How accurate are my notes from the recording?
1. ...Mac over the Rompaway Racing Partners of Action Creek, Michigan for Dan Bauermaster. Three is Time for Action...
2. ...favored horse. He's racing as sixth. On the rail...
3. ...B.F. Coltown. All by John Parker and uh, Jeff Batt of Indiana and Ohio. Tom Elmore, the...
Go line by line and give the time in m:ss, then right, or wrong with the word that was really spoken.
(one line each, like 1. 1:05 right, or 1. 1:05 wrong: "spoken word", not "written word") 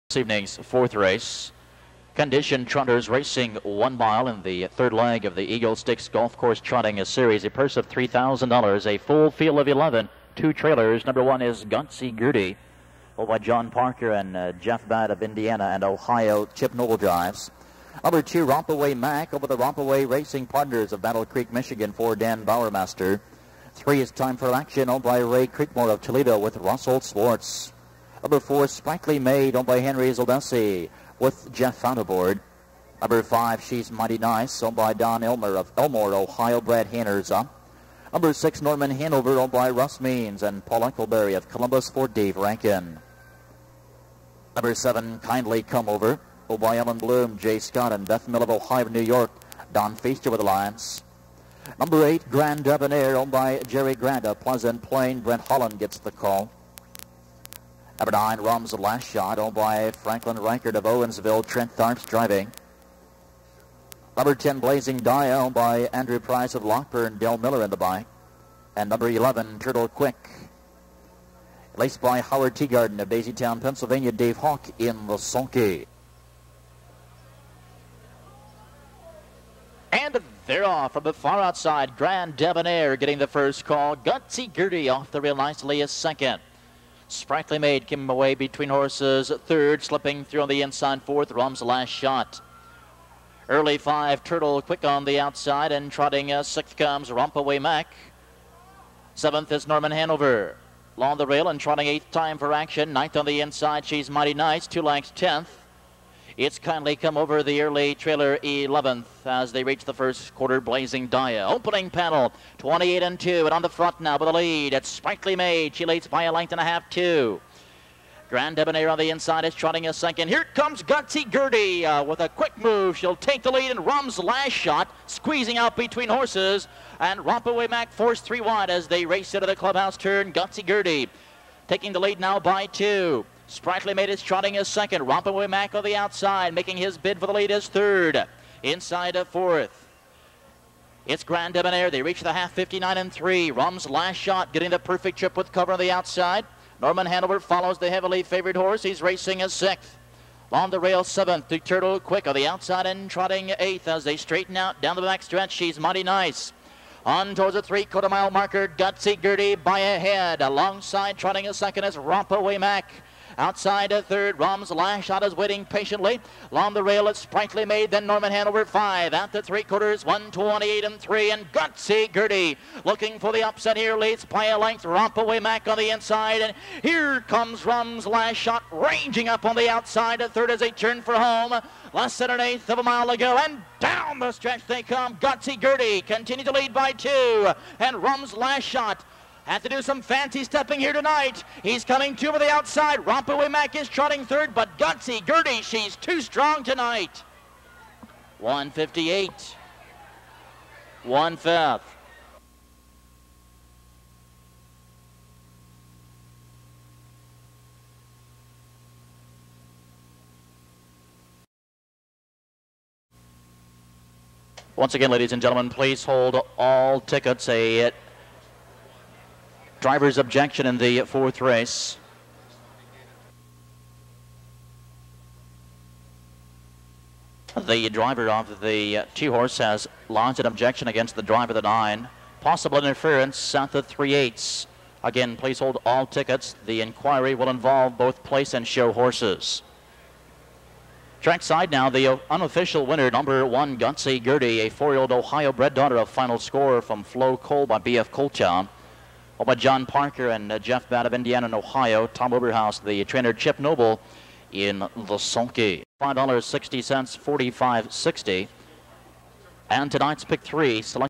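1. 0:18 wrong: "Battle", not "Action"
2. 2:28 right
3. 4:07 wrong: "Oberhaus", not "Elmore".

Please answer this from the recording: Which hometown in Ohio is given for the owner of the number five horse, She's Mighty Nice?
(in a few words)
Elmore, Ohio.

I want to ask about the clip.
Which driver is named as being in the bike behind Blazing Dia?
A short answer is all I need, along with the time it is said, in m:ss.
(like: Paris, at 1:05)
Dale Miller, at 1:07.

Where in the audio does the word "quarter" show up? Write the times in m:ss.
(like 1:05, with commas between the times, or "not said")
1:50, 2:37, 2:49.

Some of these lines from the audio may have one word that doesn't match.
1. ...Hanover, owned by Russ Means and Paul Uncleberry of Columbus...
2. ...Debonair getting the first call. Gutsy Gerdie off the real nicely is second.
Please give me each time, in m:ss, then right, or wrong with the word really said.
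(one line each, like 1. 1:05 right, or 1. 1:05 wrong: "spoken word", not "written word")
1. 0:38 right
2. 1:22 right.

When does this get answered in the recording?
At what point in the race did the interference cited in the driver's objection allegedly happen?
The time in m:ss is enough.
3:53.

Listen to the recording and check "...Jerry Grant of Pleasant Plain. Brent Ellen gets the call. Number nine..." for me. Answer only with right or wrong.
wrong.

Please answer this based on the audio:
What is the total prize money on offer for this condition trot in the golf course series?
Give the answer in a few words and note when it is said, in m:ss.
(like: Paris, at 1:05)
$3,000, at 0:07.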